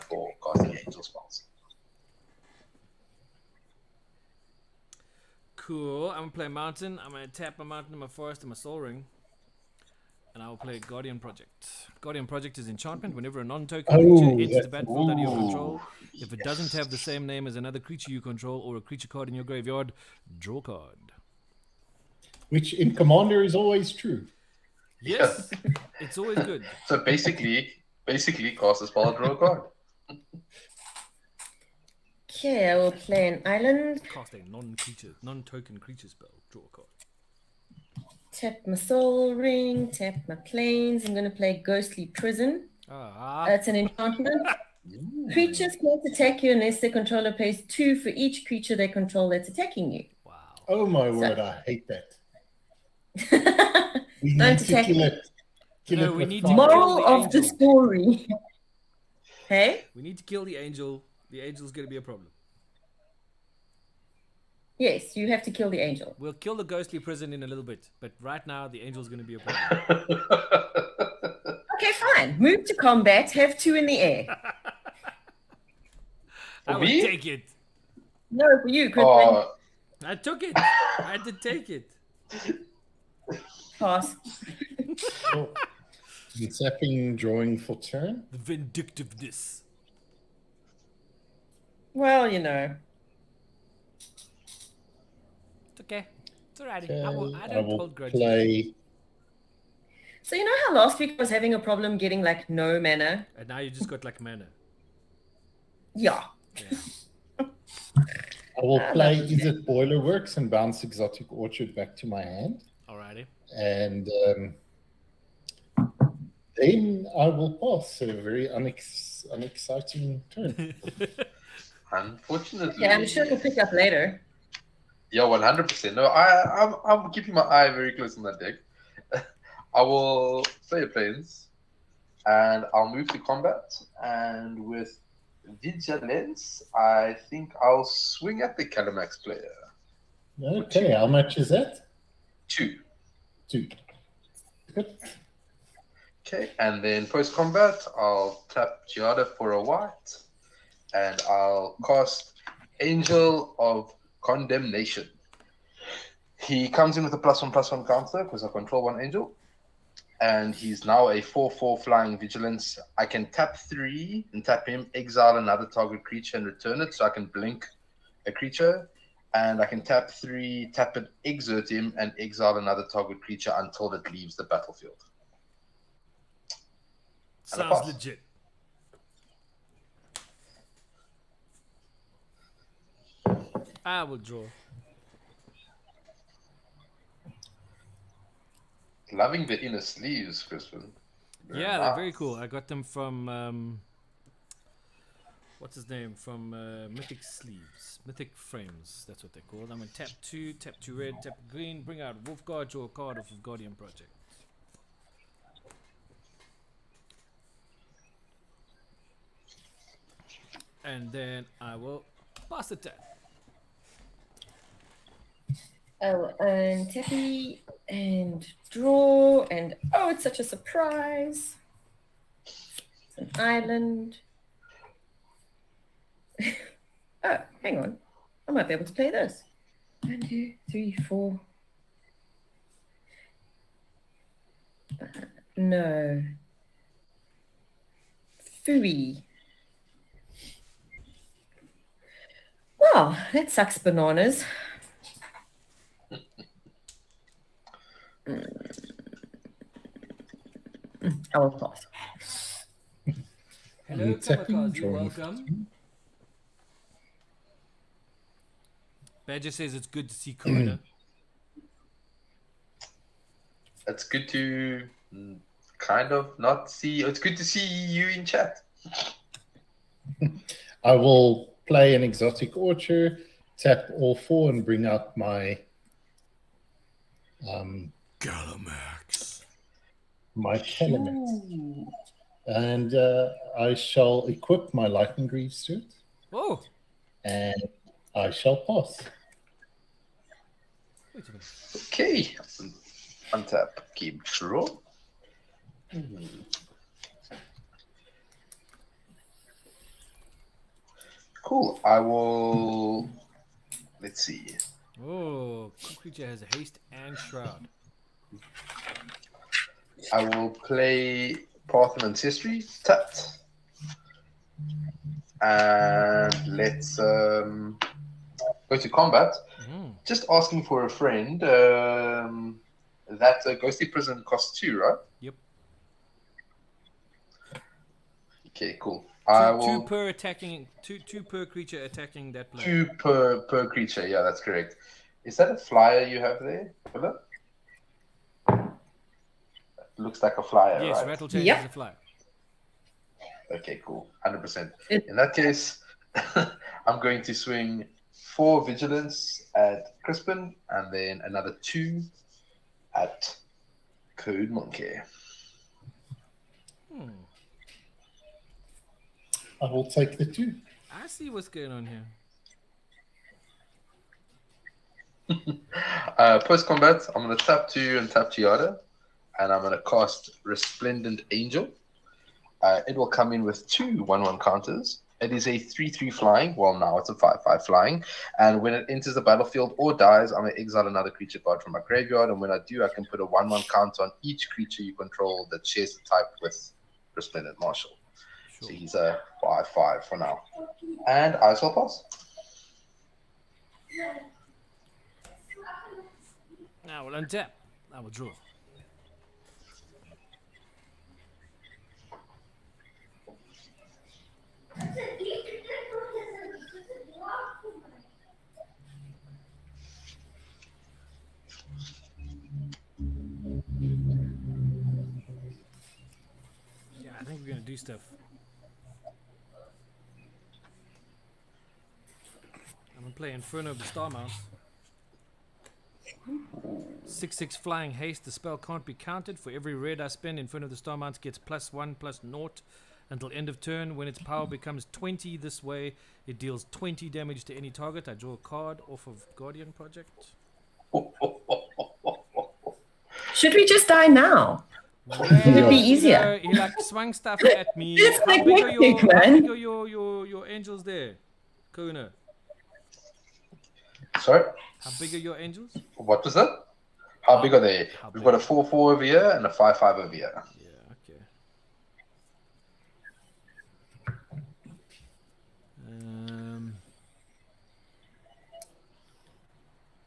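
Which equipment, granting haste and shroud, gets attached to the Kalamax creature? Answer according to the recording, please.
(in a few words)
Lightning Greaves.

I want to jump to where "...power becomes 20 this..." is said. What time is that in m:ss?
7:14.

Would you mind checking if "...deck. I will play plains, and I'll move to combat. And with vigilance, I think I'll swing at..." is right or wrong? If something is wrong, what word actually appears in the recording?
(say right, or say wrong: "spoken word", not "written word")
right.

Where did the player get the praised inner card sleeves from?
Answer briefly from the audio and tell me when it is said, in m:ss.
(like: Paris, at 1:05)
Mythic Frames, at 3:18.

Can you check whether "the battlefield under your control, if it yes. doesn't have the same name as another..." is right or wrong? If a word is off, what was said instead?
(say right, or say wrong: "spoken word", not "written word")
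right.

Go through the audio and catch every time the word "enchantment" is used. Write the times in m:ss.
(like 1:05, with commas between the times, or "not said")
0:12, 0:43.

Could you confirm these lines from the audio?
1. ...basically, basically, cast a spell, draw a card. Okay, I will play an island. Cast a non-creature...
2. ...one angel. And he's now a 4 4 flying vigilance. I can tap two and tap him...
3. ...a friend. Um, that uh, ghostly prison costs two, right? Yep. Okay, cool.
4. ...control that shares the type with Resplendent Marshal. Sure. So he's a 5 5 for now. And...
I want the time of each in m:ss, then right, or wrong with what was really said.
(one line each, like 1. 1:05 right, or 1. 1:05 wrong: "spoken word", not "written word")
1. 0:26 right
2. 2:38 wrong: "three", not "two"
3. 5:20 right
4. 6:24 right.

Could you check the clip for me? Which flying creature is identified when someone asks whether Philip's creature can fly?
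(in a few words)
Rattlechains.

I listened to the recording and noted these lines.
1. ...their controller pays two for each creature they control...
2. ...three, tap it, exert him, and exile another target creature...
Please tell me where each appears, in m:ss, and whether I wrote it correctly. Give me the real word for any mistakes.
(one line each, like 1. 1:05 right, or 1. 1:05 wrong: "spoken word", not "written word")
1. 0:46 right
2. 2:50 right.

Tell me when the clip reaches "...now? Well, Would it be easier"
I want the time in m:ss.
7:24.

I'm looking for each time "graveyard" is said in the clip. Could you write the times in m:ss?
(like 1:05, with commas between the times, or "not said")
0:19, 6:21.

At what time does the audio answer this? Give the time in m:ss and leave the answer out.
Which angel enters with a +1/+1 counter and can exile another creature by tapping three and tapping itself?
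2:32.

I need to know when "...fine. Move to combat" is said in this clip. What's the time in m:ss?
1:12.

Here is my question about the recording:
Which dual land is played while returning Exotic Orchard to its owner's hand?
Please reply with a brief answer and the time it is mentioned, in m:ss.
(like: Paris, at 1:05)
Izzet Boilerworks, at 1:49.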